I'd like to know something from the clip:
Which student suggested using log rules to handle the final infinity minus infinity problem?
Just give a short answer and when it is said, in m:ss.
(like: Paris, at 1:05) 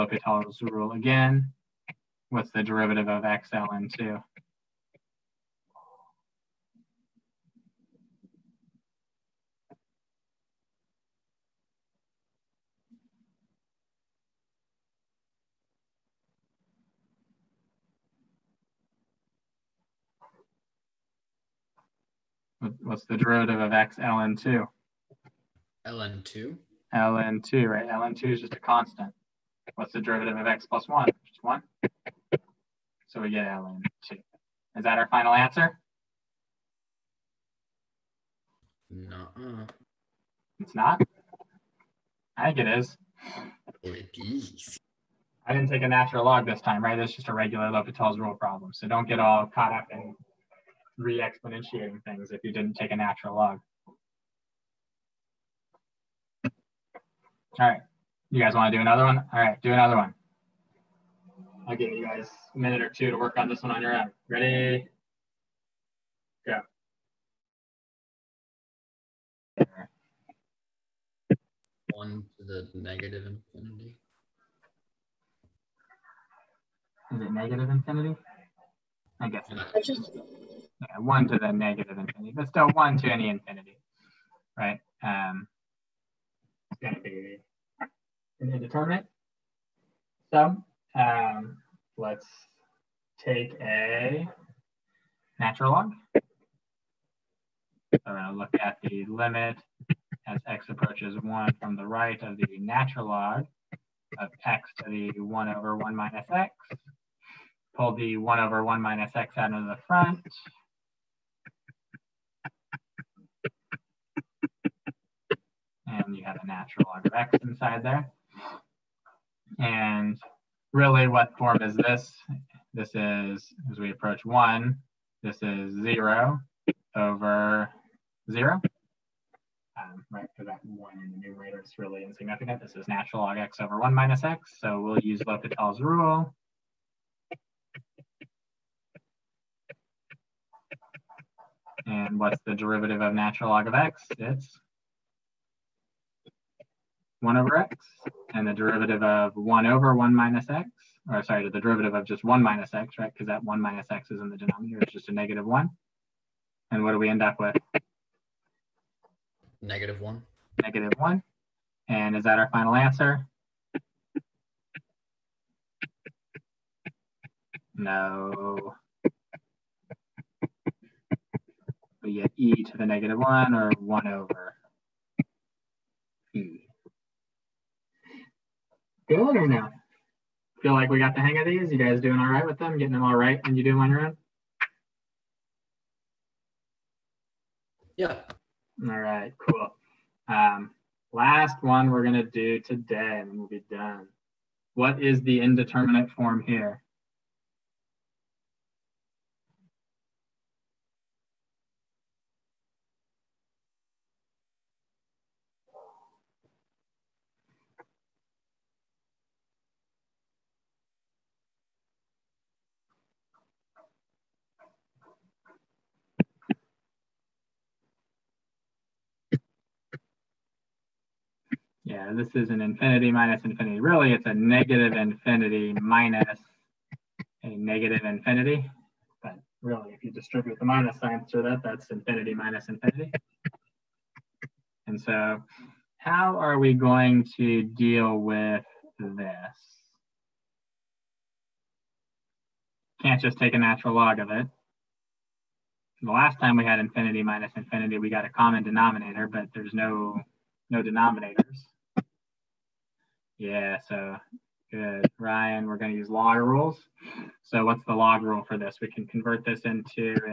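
Ryan, at 4:15.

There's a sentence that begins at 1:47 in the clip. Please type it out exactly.
Pull the 1 over 1 minus x out of the front.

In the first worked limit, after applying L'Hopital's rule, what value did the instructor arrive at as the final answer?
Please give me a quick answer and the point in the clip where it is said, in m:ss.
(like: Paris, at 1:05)
ln 2, at 0:33.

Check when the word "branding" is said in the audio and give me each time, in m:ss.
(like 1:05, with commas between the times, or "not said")
not said.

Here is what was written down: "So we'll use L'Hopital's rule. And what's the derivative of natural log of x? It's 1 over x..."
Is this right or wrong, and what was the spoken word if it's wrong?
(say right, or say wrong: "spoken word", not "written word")
right.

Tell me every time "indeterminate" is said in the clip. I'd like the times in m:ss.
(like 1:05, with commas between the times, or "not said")
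1:28, 3:15.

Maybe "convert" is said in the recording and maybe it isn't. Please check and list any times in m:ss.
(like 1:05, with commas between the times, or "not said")
4:19.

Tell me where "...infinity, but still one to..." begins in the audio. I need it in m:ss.
1:21.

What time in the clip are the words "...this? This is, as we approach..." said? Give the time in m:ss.
2:01.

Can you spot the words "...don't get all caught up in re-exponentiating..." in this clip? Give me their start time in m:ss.
0:48.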